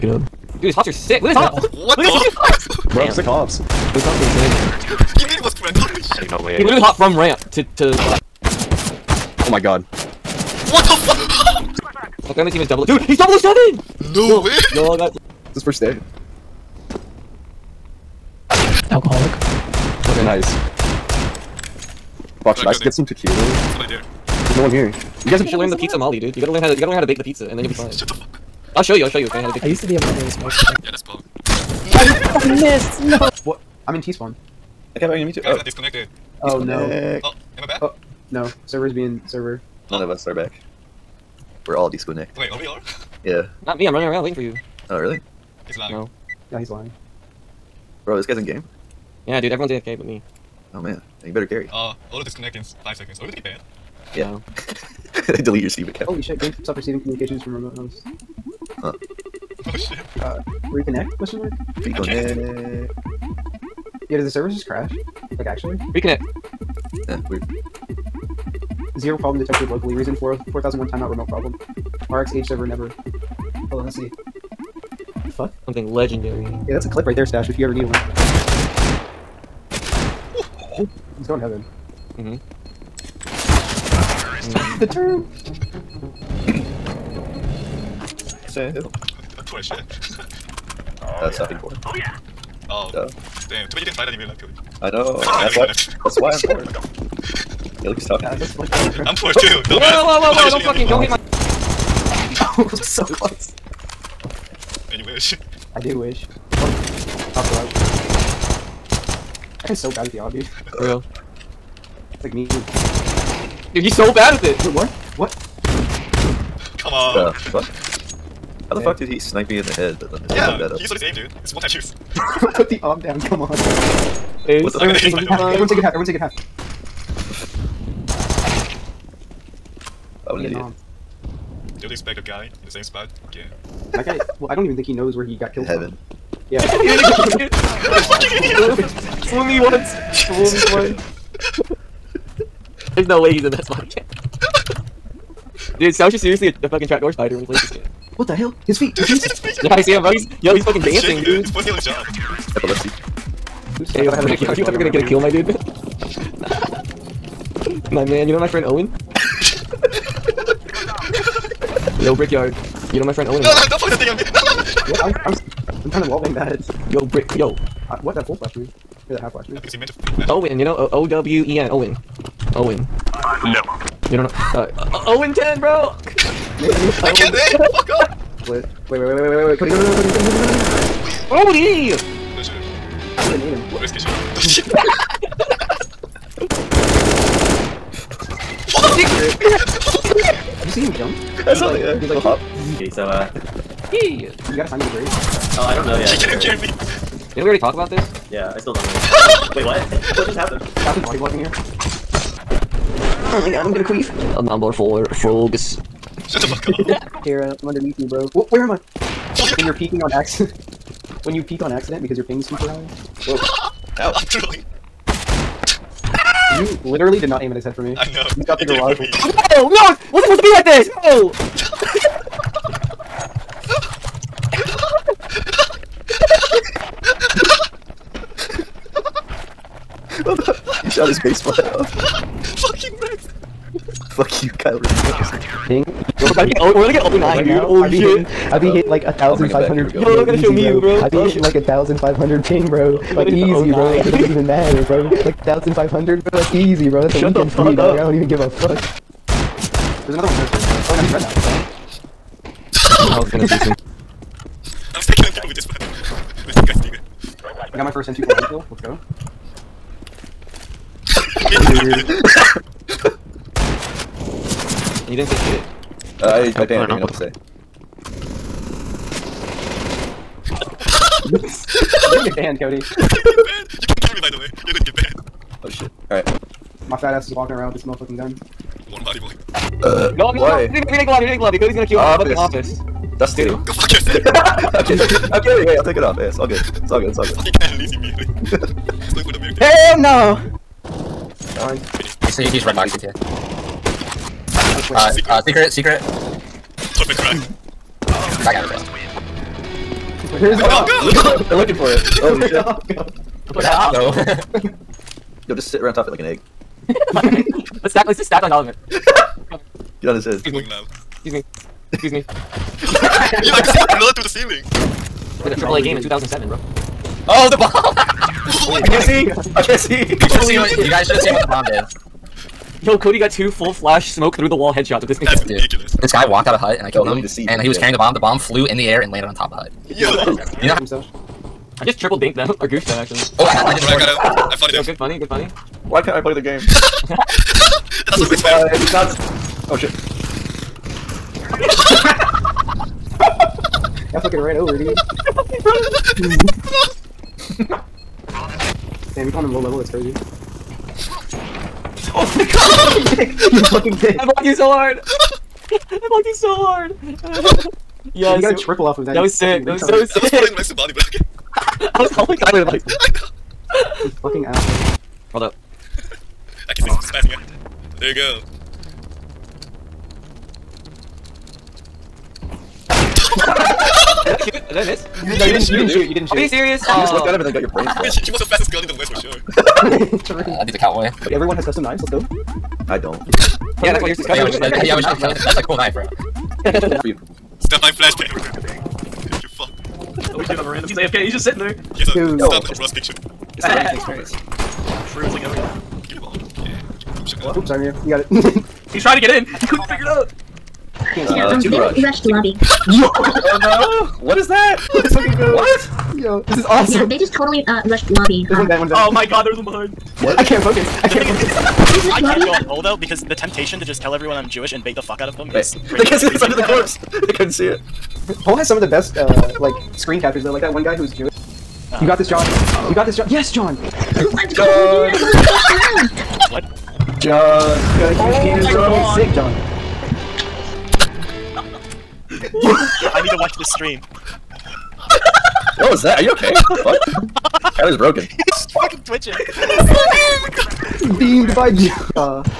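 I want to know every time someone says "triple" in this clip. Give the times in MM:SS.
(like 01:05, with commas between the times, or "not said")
05:15, 05:31, 05:58.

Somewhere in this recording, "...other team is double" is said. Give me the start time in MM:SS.
00:12.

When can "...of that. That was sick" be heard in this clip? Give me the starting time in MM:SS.
05:58.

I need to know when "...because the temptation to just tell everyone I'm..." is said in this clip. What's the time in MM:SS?
06:52.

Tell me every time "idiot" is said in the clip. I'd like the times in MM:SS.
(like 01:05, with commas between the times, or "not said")
02:11, 02:18.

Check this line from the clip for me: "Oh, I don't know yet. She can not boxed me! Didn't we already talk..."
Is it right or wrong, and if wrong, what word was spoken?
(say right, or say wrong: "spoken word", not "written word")
wrong: "cured", not "boxed".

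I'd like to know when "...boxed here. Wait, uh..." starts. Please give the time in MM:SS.
04:52.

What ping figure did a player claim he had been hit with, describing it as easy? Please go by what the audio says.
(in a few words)
1,500.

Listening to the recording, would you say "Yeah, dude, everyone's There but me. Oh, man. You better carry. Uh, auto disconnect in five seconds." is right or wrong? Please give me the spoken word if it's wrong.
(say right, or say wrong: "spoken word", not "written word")
wrong: "AFK", not "There".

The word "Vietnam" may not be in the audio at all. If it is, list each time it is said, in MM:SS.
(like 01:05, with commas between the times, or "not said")
02:10.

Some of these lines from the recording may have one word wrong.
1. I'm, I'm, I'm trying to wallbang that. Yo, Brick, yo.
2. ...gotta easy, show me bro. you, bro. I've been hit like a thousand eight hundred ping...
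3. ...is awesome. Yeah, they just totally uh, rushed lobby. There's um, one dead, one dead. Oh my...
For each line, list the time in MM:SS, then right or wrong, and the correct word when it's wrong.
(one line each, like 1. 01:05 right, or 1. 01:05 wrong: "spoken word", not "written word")
1. 02:45 right
2. 04:00 wrong: "five", not "eight"
3. 06:46 right.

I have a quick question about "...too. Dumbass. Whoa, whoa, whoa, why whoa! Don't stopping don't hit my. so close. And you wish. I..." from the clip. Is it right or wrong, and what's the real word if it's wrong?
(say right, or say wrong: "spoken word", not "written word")
wrong: "fucking", not "stopping".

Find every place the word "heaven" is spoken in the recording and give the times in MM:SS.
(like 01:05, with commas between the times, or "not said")
01:21, 02:15.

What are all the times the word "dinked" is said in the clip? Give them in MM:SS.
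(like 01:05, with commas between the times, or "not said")
05:32.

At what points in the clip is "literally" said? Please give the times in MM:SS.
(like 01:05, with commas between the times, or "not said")
00:06, 03:36.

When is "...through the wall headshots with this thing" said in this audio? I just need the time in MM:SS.
05:24.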